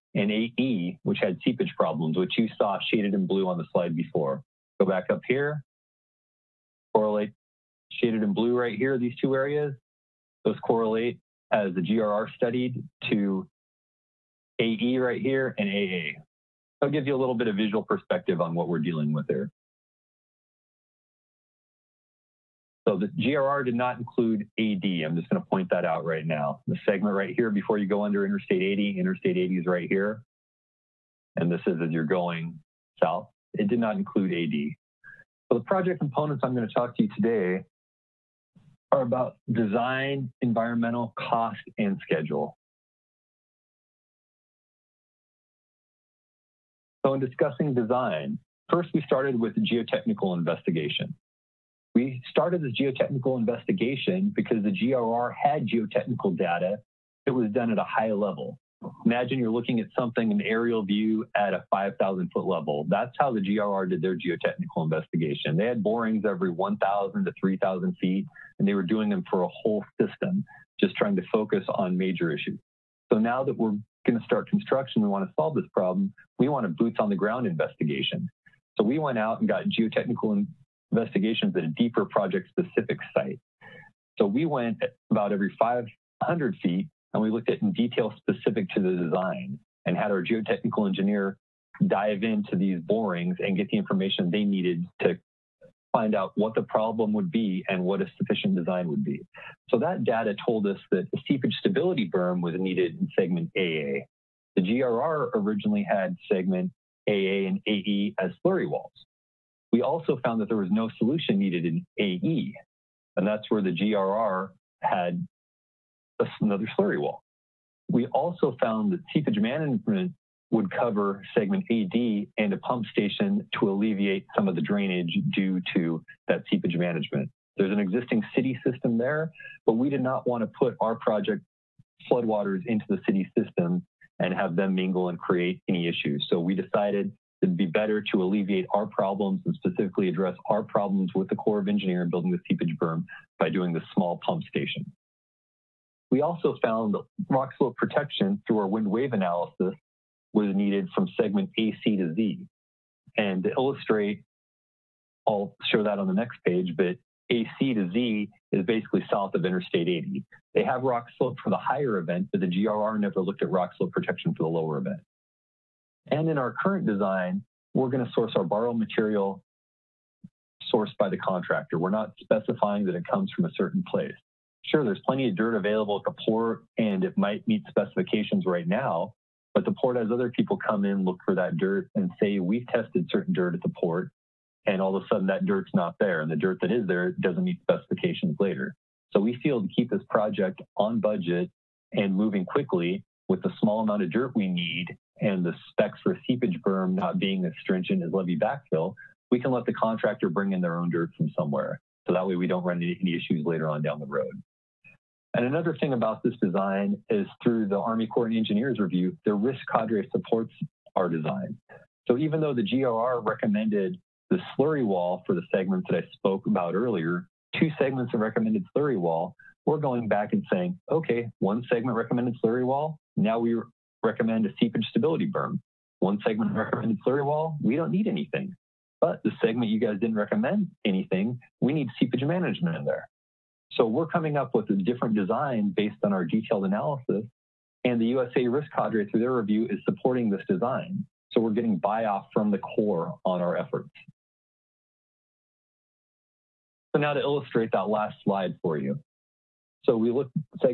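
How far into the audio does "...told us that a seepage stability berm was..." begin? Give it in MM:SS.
01:40.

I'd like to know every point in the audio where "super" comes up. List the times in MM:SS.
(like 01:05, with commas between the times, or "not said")
not said.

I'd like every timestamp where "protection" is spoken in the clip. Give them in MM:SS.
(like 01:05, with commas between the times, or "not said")
02:27, 02:43.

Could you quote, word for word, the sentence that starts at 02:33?
And to illustrate, I'll show that on the next page, but AC to Z is basically south of Interstate 80.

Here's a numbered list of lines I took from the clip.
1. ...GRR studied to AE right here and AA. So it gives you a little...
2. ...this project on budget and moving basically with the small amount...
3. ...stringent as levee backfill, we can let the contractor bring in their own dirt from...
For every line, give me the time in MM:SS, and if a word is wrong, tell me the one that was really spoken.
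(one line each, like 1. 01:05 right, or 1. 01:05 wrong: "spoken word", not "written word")
1. 00:11 right
2. 03:09 wrong: "quickly", not "basically"
3. 03:17 right.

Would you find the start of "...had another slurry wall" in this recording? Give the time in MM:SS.
01:54.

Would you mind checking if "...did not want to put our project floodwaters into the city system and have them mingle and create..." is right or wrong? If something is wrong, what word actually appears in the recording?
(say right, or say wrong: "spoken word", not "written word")
right.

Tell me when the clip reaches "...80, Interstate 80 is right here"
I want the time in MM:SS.
00:28.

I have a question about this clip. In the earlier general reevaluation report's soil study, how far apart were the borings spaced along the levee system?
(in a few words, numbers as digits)
1,000 to 3,000 feet.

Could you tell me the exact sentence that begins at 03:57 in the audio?
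And the USA risk cadre through their review is supporting this design.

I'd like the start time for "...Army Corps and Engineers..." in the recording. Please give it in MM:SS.
03:27.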